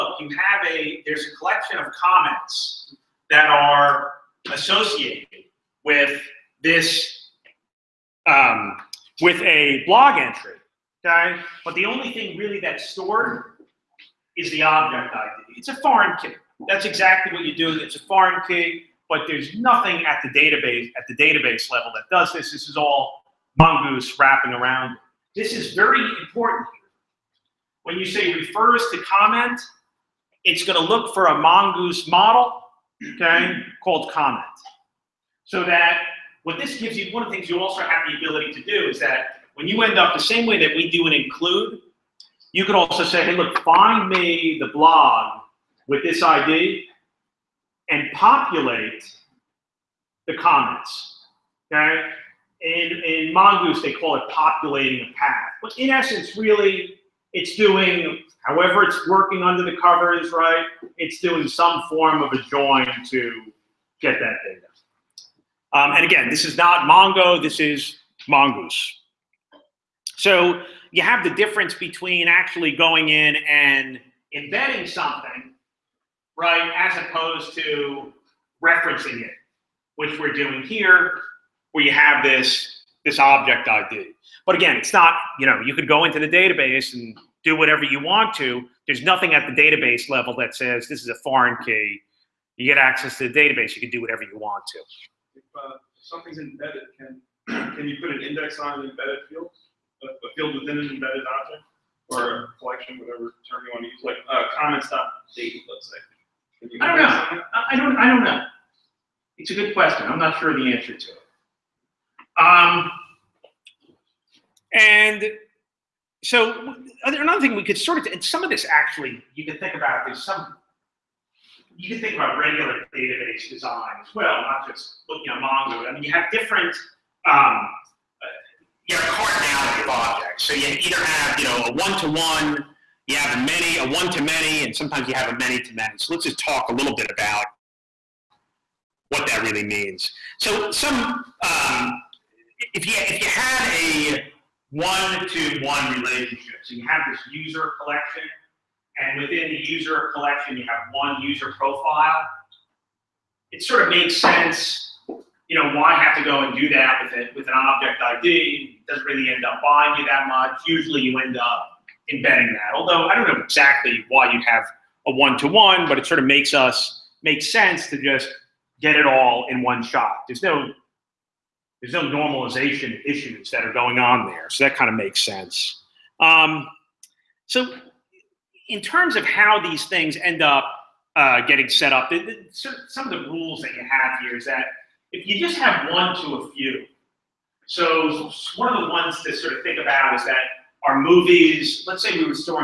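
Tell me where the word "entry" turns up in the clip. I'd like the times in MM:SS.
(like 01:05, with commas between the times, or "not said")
00:10.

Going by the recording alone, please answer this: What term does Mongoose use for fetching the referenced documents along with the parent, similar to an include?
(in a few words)
populating a path.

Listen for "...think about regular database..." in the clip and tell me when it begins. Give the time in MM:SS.
02:01.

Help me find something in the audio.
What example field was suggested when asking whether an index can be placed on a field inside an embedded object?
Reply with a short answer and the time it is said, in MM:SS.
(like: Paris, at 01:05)
stop date, at 01:44.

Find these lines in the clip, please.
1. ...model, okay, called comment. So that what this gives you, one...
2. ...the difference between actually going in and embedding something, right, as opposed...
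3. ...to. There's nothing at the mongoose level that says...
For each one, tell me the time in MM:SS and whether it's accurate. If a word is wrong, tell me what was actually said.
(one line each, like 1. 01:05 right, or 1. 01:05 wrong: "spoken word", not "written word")
1. 00:32 right
2. 01:11 right
3. 01:28 wrong: "database", not "mongoose".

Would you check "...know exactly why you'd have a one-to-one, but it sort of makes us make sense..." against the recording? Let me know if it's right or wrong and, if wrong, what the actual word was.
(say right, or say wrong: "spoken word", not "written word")
right.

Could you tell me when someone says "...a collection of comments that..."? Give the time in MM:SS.
00:01.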